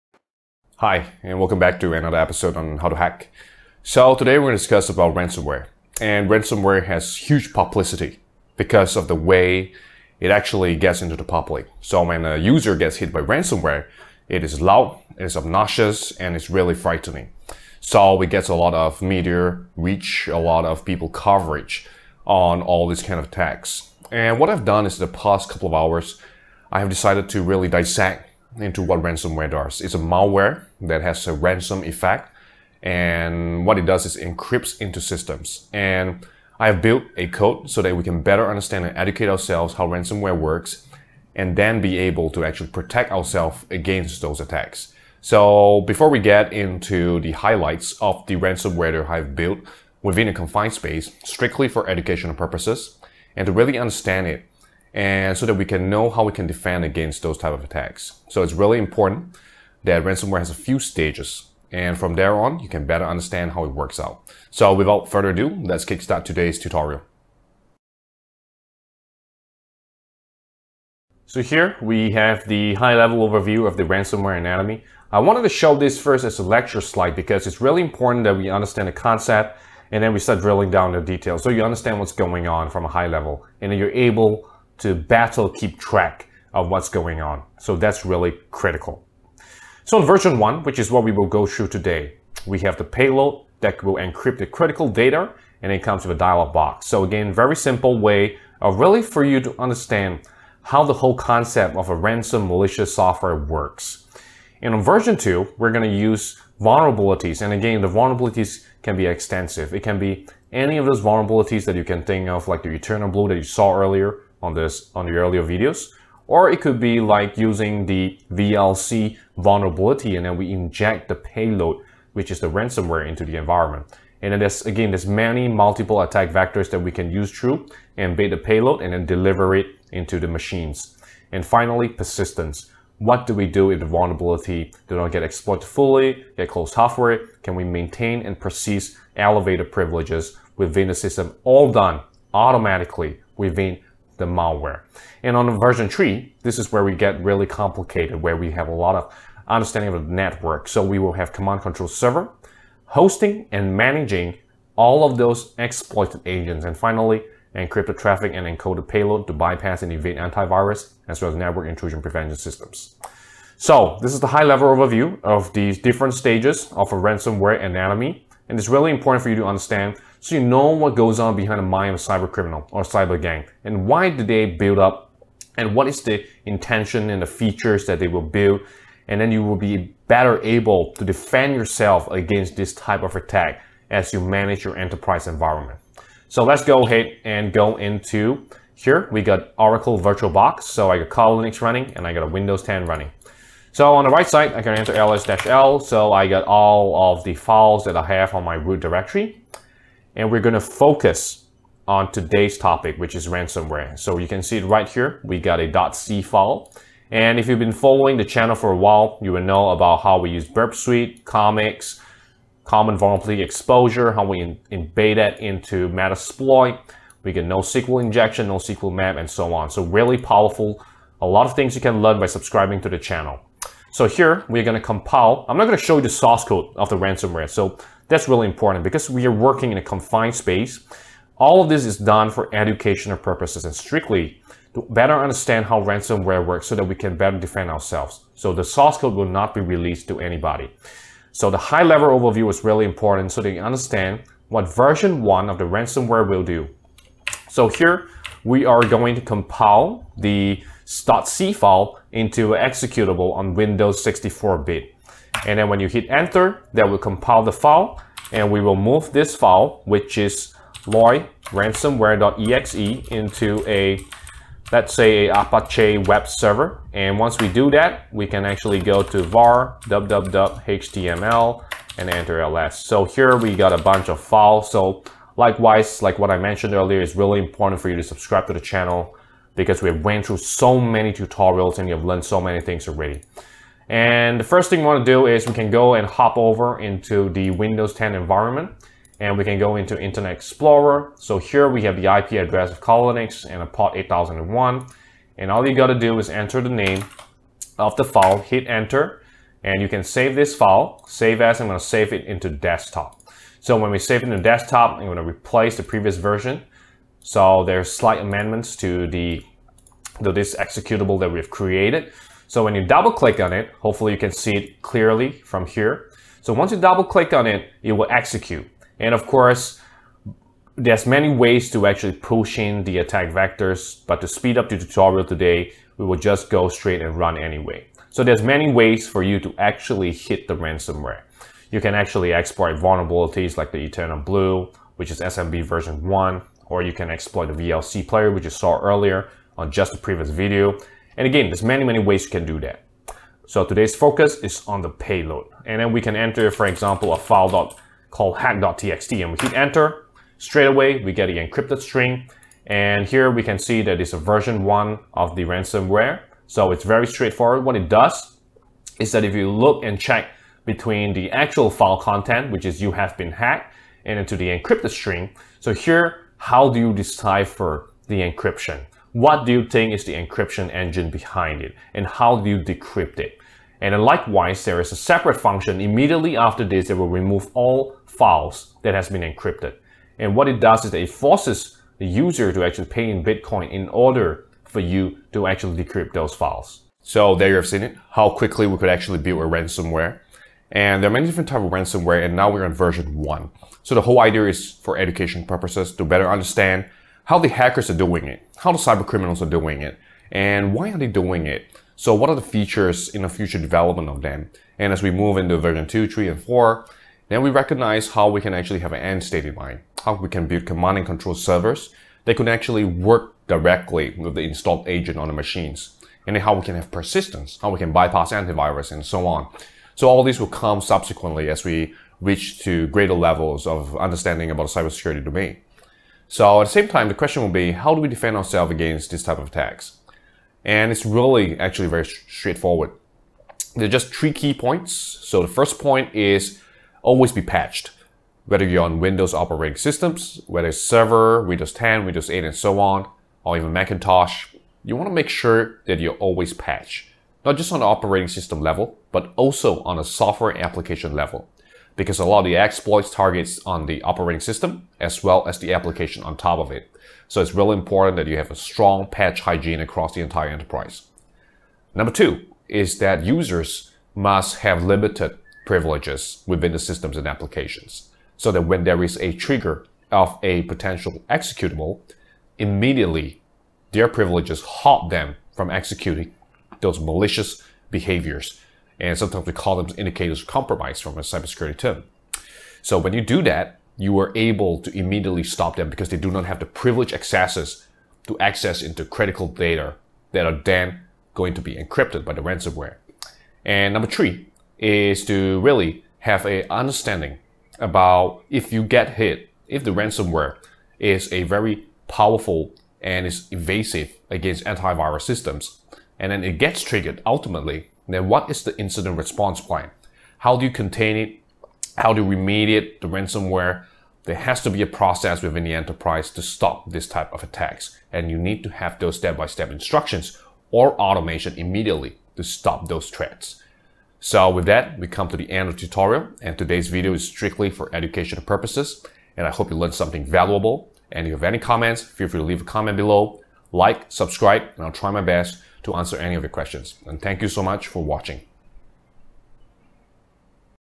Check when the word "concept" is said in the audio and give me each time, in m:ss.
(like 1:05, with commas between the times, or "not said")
1:18, 1:41.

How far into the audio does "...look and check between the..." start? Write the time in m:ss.
5:59.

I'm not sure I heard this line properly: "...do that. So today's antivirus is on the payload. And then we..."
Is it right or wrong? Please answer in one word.
wrong.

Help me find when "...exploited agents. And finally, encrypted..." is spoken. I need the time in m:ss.
2:35.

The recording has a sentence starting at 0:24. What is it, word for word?
And what I've done is the past couple of hours, I have decided to really dissect into what ransomware does.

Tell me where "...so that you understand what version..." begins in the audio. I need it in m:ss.
4:03.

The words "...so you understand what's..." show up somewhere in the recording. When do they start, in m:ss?
1:21.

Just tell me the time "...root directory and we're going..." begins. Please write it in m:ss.
3:18.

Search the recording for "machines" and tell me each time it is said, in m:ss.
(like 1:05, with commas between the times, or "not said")
2:10, 6:55.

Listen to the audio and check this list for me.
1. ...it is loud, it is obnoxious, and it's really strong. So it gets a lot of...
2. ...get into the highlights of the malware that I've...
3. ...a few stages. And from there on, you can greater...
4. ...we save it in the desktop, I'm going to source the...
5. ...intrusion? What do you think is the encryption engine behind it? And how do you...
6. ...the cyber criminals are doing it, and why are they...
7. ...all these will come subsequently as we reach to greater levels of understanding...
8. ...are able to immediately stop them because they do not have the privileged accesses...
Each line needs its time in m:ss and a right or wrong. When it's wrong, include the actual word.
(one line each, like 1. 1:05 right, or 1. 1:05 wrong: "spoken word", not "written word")
1. 0:14 wrong: "frightening", not "strong"
2. 0:46 wrong: "ransomware", not "malware"
3. 1:00 wrong: "better", not "greater"
4. 5:03 wrong: "replace", not "source"
5. 6:08 wrong: "encryption", not "intrusion"
6. 6:38 right
7. 7:00 right
8. 8:04 right.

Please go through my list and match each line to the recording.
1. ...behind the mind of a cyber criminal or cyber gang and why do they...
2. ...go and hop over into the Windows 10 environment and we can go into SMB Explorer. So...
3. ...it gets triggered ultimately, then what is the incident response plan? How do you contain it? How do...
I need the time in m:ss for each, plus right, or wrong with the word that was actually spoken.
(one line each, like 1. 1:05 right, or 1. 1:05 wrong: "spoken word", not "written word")
1. 2:51 right
2. 4:45 wrong: "Internet", not "SMB"
3. 8:26 right.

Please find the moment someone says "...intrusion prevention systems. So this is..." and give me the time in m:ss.
2:41.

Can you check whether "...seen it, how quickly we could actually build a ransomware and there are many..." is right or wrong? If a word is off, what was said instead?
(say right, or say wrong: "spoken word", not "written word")
right.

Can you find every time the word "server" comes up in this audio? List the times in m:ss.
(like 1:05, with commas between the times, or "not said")
2:31, 4:26, 6:51, 7:20.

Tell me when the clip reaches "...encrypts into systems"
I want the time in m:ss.
0:34.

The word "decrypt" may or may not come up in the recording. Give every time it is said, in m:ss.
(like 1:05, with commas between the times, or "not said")
6:12, 6:25.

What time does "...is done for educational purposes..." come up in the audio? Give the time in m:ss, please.
3:51.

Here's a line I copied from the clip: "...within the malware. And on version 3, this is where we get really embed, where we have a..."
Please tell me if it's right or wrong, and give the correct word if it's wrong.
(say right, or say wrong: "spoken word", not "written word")
wrong: "complicated", not "embed".